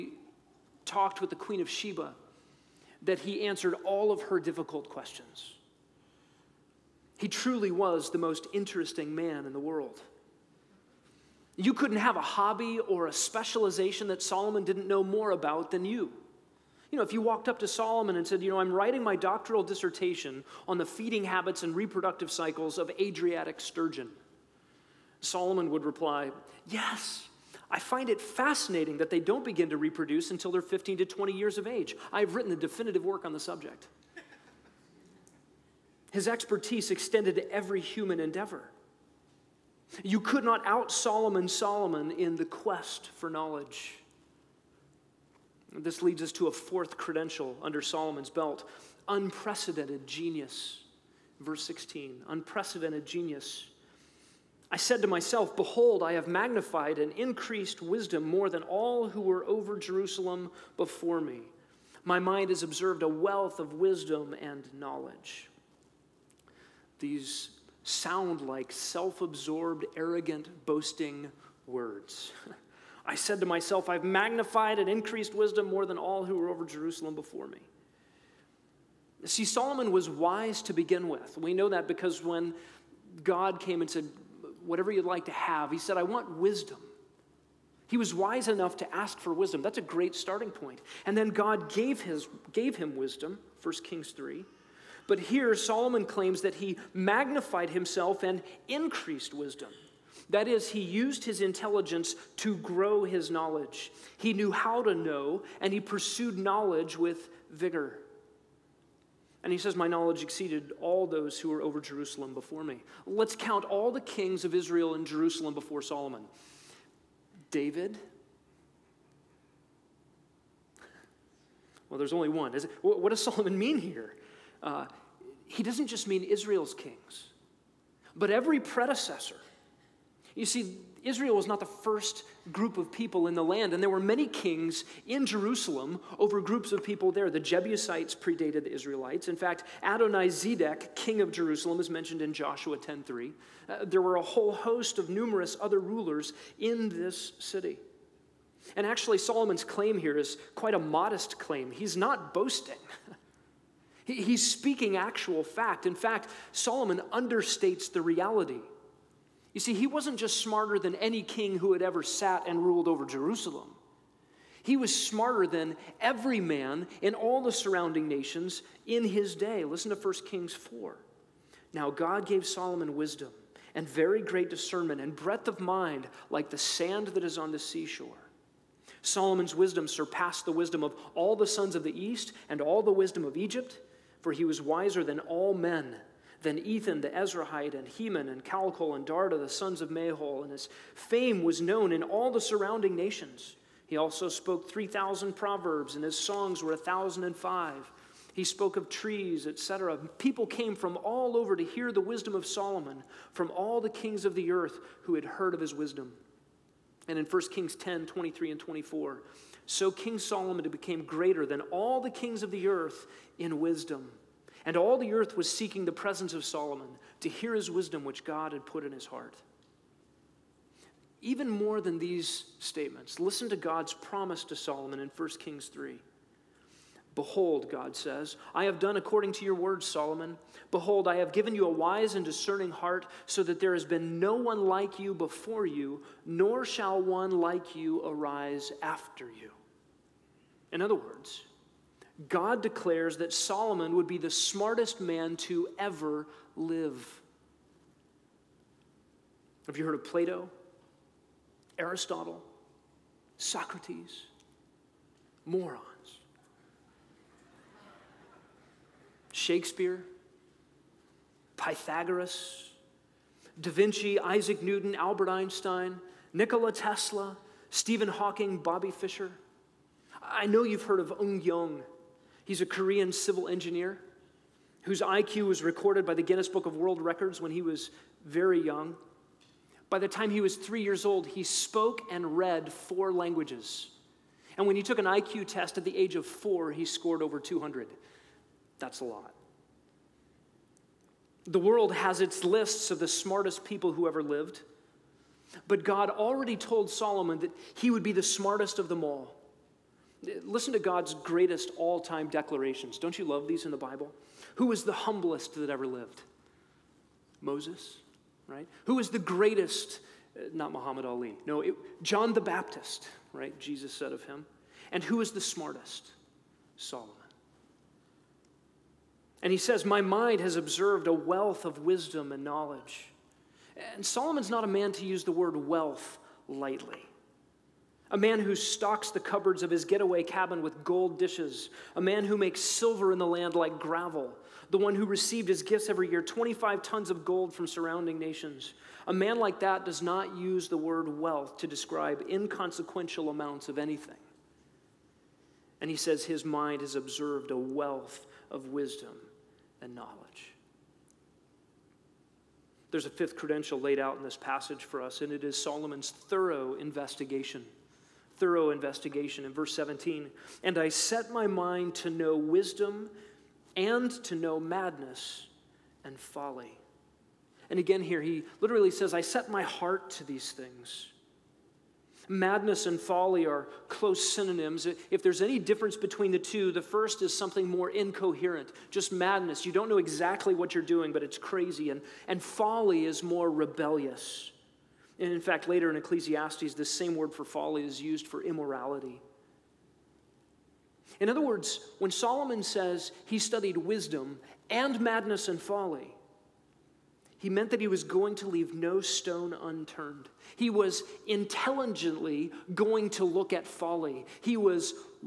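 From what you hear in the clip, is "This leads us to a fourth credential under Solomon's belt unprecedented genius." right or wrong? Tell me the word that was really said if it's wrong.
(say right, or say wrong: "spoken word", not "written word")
right.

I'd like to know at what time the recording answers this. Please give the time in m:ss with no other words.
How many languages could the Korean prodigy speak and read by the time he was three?
4:42.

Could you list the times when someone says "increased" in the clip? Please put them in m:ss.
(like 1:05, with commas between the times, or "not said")
0:57, 1:14, 1:38.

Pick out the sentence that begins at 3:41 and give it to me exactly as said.
Even more than these statements, listen to God's promise to Solomon in 1 Kings 3.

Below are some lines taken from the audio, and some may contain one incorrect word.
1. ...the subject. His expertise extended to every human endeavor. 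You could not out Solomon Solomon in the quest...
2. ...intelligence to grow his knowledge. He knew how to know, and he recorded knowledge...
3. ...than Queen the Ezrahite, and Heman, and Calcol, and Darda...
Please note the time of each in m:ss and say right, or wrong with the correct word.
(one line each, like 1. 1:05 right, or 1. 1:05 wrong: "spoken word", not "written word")
1. 0:33 right
2. 1:41 wrong: "pursued", not "recorded"
3. 3:06 wrong: "Ethan", not "Queen".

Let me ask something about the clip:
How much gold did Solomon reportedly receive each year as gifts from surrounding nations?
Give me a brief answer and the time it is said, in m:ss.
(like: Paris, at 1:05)
25 tons, at 5:36.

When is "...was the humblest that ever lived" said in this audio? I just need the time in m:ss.
5:04.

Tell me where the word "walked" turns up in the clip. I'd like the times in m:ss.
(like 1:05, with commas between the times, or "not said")
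0:17.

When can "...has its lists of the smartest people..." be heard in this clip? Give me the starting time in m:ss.
4:51.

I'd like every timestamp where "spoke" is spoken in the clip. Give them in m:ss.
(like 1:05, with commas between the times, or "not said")
3:14, 3:18, 4:41.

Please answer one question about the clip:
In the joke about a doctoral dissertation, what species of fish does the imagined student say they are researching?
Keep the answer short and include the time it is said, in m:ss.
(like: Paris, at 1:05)
Adriatic sturgeon, at 0:22.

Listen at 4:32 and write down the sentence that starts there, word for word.
He's a Korean civil engineer whose IQ was recorded by the Guinness Book of World Records when he was very young.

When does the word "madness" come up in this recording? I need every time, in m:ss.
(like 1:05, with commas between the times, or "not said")
6:04, 6:12, 6:19, 6:35.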